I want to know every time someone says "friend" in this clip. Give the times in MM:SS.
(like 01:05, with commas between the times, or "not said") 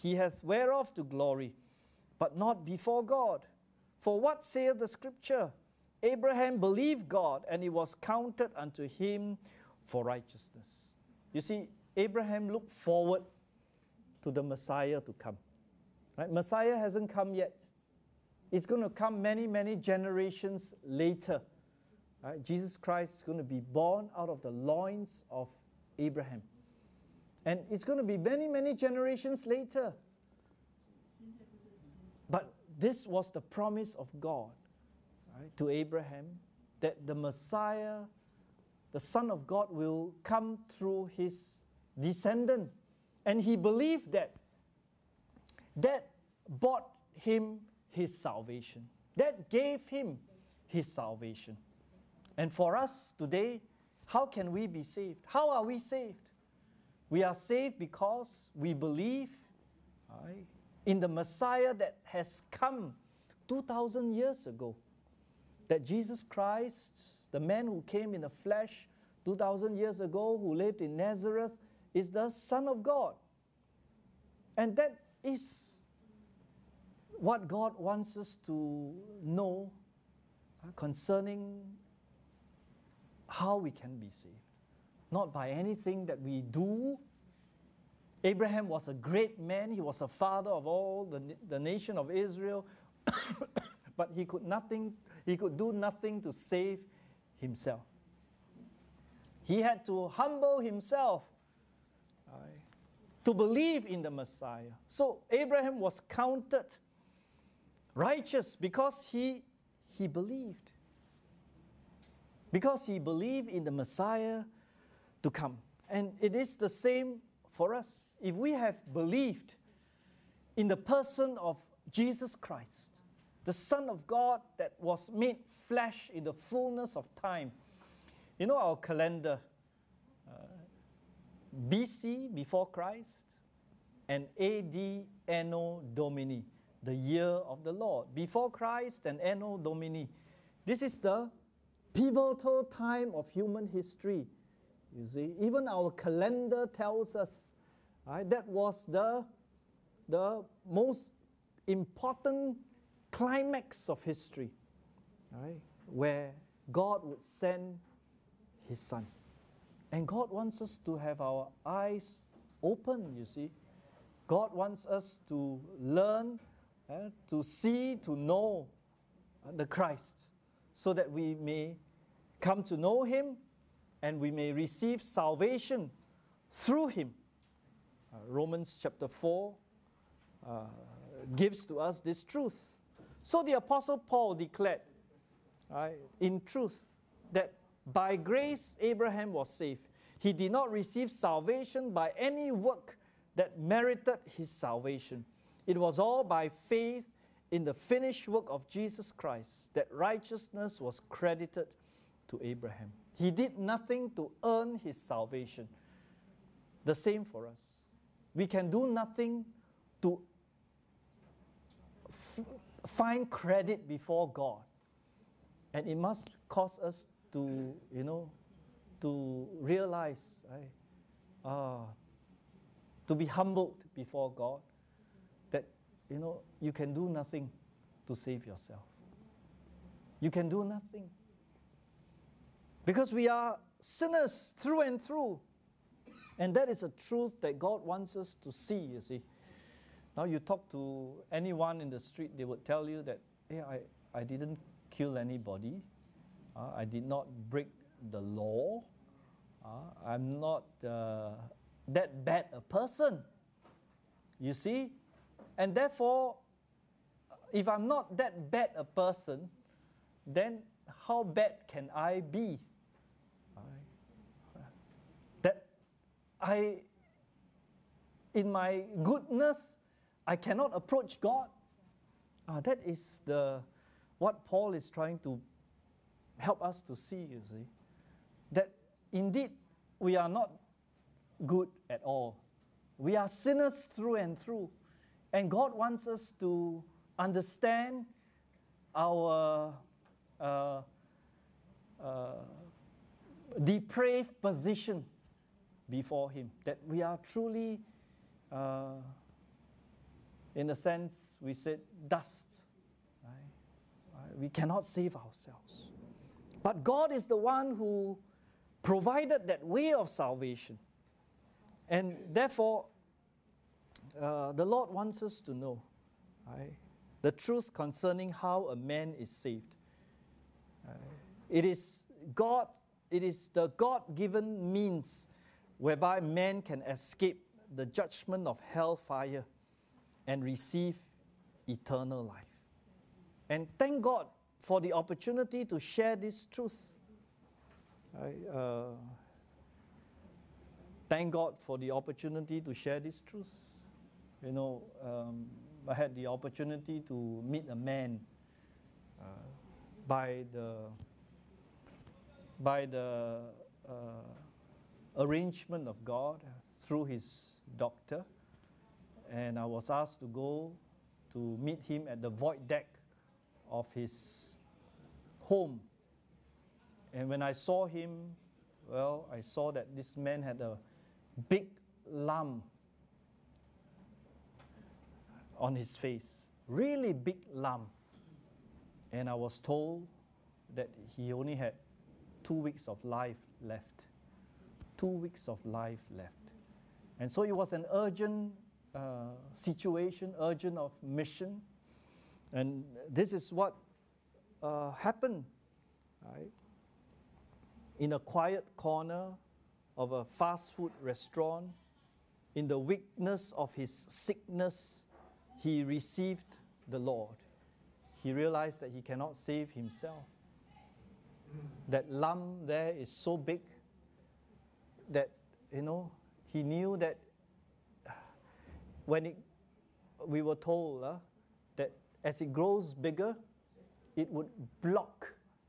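not said.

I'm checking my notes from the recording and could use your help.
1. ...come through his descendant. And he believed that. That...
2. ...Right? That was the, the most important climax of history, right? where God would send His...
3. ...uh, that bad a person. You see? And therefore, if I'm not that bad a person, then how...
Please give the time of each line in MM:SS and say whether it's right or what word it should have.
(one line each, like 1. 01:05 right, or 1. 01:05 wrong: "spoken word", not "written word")
1. 00:40 right
2. 02:28 right
3. 04:10 right.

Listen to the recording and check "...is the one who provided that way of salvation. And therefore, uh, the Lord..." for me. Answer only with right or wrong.
right.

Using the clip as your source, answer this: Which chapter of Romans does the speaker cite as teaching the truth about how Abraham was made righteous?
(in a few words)
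Romans chapter 4.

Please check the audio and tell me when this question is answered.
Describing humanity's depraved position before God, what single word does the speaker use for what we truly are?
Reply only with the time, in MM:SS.
05:02.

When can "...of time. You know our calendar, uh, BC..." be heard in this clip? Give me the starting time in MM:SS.
02:06.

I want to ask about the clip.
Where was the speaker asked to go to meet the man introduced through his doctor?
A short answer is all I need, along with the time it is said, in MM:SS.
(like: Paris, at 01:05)
the void deck of his home, at 06:02.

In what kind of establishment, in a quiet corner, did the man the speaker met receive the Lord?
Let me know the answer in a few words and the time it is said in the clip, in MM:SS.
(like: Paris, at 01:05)
a fast food restaurant, at 06:40.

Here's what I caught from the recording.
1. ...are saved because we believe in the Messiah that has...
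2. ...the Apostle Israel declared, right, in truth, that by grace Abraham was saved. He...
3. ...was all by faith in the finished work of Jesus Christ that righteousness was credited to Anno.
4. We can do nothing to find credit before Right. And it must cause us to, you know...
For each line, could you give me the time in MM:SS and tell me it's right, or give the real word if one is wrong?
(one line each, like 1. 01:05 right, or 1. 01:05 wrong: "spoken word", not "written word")
1. 00:57 right
2. 03:03 wrong: "Paul", not "Israel"
3. 03:15 wrong: "Abraham", not "Anno"
4. 03:28 wrong: "God", not "Right".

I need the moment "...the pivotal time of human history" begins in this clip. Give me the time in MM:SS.
02:20.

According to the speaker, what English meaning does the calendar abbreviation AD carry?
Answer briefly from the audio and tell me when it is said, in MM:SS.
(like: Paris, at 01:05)
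the year of the Lord, at 02:16.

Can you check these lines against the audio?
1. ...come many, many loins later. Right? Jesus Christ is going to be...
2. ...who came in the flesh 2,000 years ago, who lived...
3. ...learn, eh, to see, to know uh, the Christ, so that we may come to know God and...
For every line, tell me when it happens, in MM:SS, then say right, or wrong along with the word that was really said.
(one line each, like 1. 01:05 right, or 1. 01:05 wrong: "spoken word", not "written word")
1. 00:18 wrong: "generations", not "loins"
2. 01:07 right
3. 02:45 wrong: "Him", not "God".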